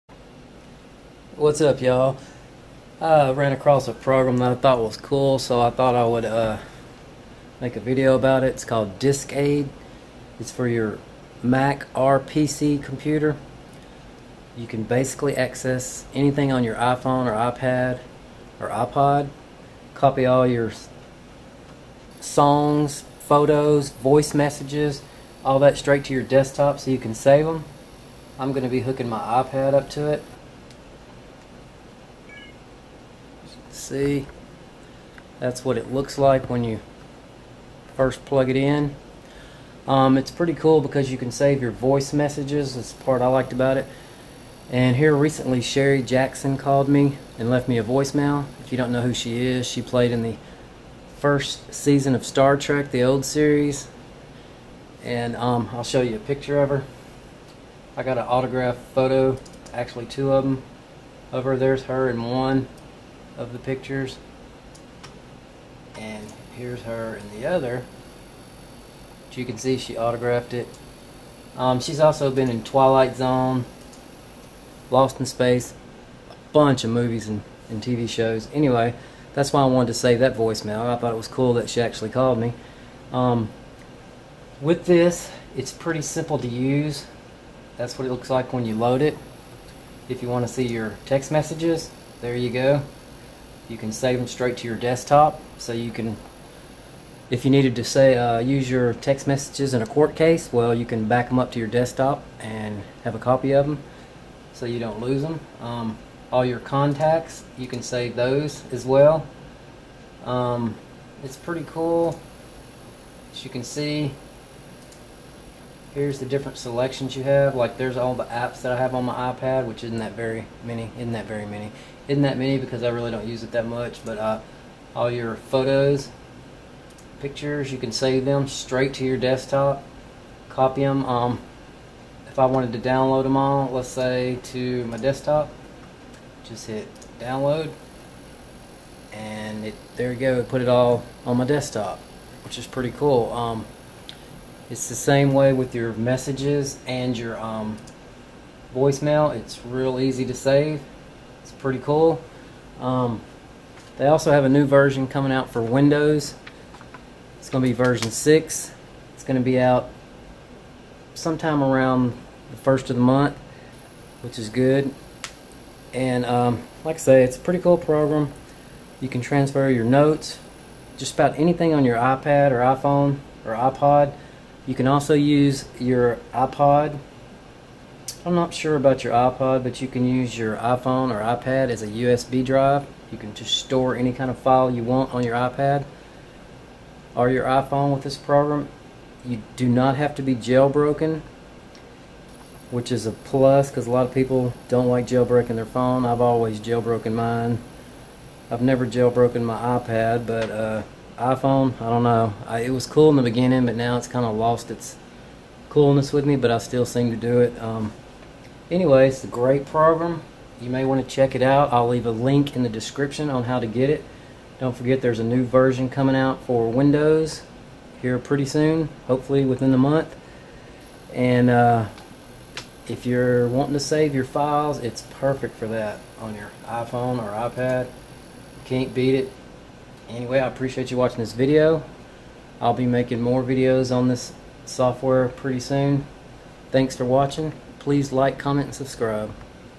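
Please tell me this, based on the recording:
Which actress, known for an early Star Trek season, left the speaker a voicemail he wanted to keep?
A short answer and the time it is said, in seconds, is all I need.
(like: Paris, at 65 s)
Sherry Jackson, at 45 s.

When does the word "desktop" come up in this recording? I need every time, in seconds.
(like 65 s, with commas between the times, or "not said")
26 s, 94 s, 101 s, 129 s, 134 s, 141 s.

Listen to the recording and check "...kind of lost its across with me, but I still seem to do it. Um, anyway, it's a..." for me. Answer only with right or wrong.
wrong.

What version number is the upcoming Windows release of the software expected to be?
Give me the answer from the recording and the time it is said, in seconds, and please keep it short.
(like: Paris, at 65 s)
6, at 157 s.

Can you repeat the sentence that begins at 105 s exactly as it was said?
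Um, all your contacts, you can save those as well.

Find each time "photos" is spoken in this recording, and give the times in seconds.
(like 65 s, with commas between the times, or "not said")
23 s, 58 s, 125 s.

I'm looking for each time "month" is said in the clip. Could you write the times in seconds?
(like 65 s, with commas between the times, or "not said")
163 s, 219 s.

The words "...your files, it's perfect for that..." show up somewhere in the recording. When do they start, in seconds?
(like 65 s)
224 s.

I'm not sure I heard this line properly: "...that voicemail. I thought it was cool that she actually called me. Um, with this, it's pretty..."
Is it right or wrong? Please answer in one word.
right.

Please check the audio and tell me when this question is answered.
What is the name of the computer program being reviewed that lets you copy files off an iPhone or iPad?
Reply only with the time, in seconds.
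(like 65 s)
8 s.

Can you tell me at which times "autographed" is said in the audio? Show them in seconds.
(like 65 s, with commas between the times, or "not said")
58 s, 69 s.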